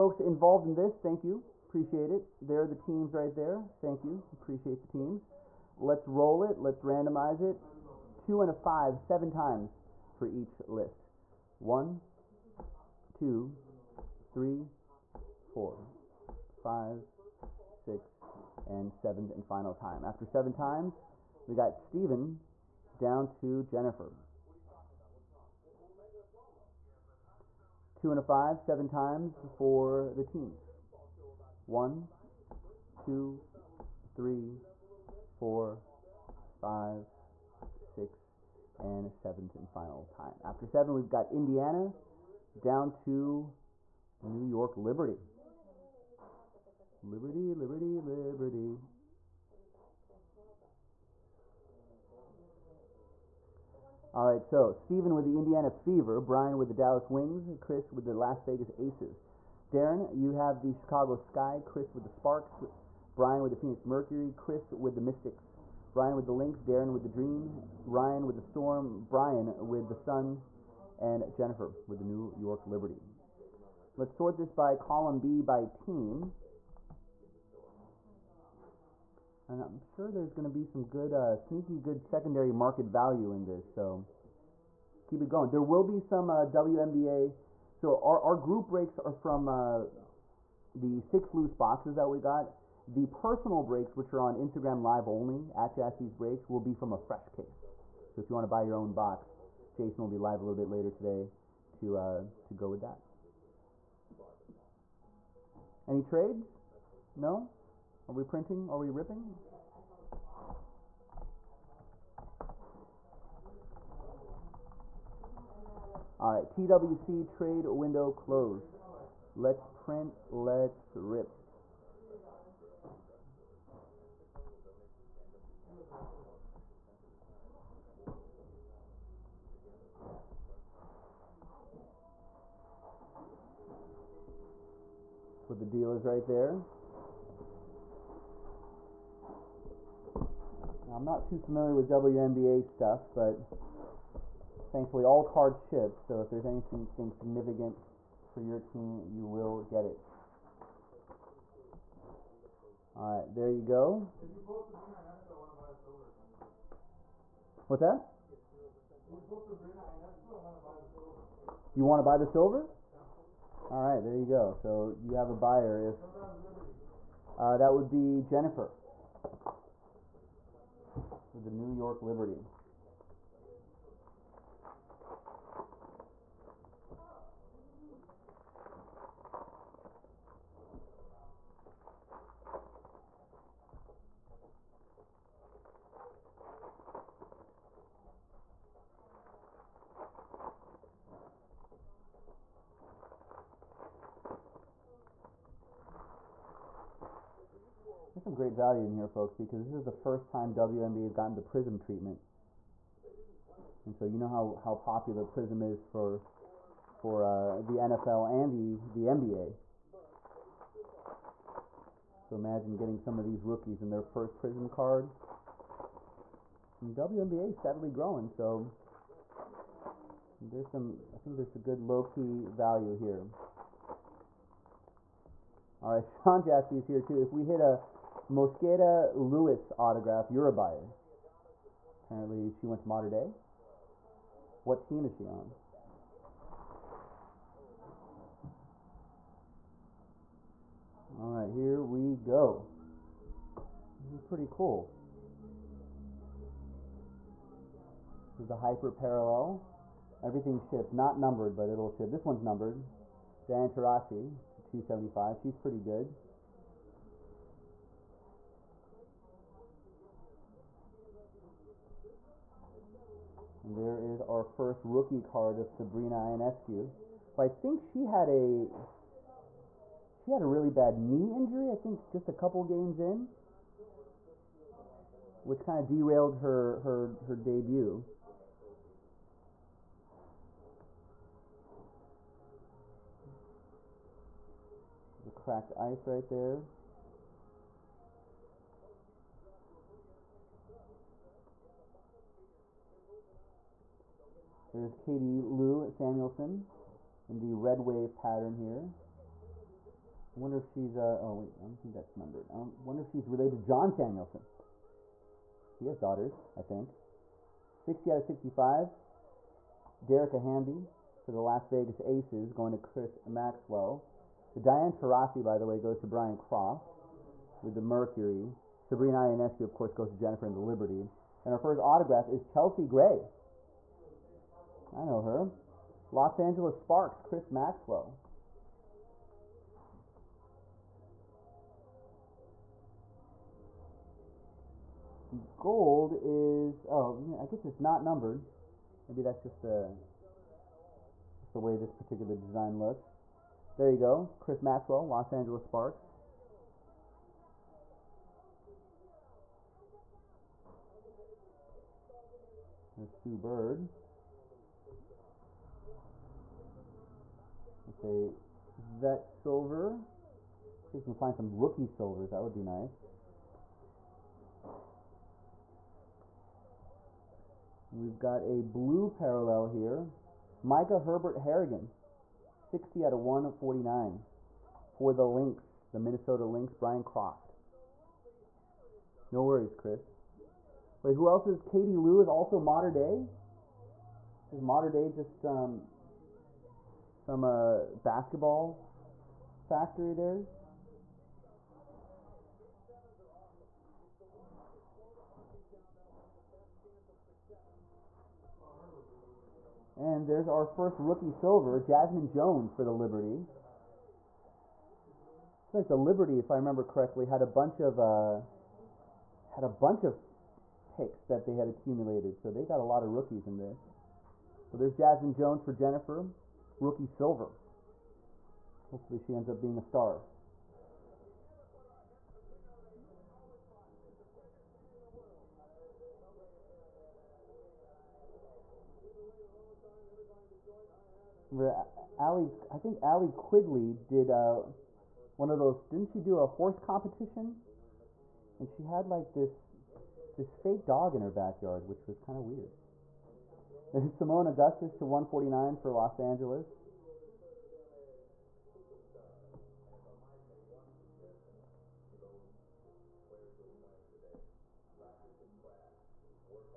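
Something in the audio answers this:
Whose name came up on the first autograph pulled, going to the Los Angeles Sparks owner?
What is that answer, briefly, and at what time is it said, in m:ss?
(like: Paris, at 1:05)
Chelsea Gray, at 5:22.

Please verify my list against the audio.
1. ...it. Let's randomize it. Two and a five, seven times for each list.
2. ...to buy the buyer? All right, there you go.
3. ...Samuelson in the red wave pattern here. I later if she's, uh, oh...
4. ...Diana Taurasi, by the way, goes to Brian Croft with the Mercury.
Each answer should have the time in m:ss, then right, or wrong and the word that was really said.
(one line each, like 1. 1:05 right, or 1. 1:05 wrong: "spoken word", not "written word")
1. 0:06 right
2. 2:42 wrong: "silver", not "buyer"
3. 4:55 wrong: "wonder", not "later"
4. 5:14 right.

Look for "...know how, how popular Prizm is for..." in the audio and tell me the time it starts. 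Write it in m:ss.
3:24.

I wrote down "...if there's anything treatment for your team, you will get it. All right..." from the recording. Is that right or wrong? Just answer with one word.
wrong.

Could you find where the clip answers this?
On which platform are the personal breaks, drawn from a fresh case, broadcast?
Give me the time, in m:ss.
1:34.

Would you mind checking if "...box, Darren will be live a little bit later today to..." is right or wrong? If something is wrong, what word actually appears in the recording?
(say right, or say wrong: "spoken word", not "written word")
wrong: "Jason", not "Darren".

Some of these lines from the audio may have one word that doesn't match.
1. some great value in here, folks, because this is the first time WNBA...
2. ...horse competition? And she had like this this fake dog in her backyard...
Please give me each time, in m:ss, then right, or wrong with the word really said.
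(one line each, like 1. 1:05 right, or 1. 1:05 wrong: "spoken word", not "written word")
1. 3:18 right
2. 7:16 right.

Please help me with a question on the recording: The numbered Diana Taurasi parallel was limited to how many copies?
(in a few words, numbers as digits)
275.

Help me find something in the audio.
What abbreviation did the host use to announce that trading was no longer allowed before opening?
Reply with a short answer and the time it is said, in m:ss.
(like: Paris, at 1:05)
TWC, at 1:56.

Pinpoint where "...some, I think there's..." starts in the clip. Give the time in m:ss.
3:40.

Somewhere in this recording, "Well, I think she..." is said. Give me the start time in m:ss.
4:27.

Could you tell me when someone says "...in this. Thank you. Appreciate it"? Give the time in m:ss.
0:00.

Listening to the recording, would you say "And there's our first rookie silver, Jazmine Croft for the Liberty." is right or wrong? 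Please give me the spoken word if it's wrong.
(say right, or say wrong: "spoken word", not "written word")
wrong: "Jones", not "Croft".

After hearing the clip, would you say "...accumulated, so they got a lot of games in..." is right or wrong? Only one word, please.
wrong.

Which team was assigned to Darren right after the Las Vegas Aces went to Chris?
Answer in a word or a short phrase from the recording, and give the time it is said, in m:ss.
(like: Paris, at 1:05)
Chicago Sky, at 1:00.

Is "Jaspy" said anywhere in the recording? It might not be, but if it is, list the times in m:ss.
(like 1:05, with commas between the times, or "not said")
1:35, 3:46.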